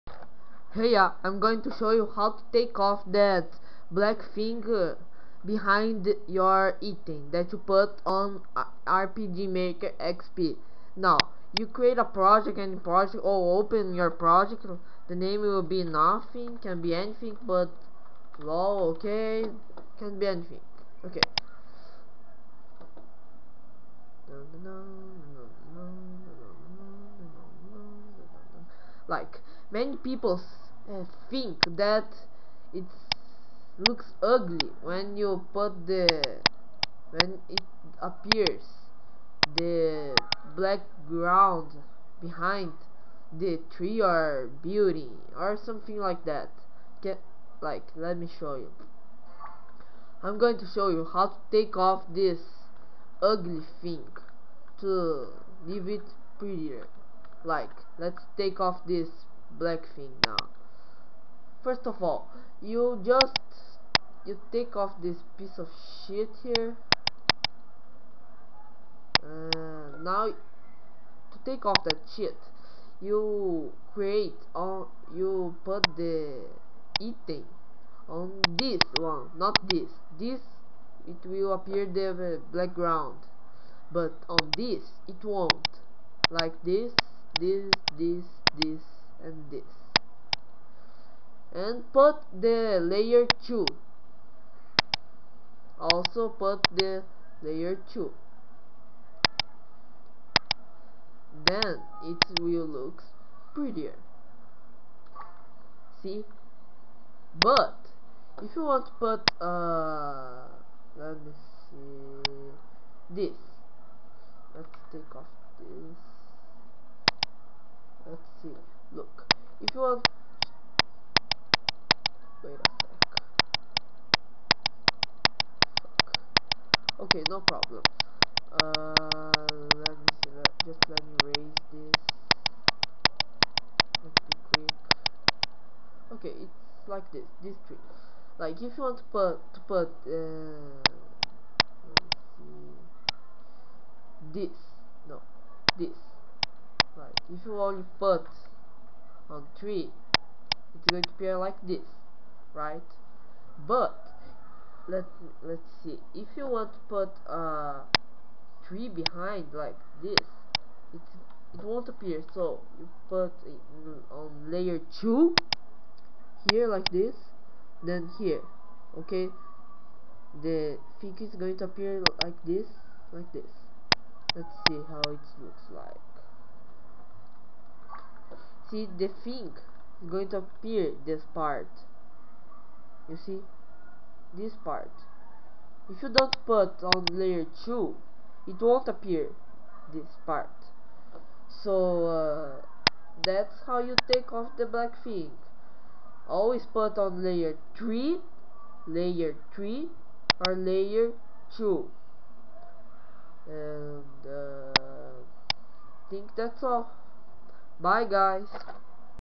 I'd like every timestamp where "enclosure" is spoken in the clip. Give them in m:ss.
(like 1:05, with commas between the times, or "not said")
not said.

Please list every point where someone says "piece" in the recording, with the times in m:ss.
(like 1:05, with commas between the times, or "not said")
1:05.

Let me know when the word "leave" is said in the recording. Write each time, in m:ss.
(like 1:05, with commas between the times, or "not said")
0:55.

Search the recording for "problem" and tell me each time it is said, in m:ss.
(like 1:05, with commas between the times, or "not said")
2:07.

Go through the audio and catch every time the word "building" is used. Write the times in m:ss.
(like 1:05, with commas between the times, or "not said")
0:44.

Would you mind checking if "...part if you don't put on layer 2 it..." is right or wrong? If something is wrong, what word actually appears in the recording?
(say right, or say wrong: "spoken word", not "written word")
right.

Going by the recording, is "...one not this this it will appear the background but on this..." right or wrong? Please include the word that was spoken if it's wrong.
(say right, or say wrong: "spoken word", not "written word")
right.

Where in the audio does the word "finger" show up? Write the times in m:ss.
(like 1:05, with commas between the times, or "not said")
0:04.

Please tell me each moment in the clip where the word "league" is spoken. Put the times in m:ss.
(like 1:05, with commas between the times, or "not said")
not said.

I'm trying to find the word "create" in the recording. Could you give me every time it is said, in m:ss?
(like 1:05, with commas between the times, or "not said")
0:11, 1:13.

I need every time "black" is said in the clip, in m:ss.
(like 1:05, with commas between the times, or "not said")
0:03, 0:40, 0:59, 3:14.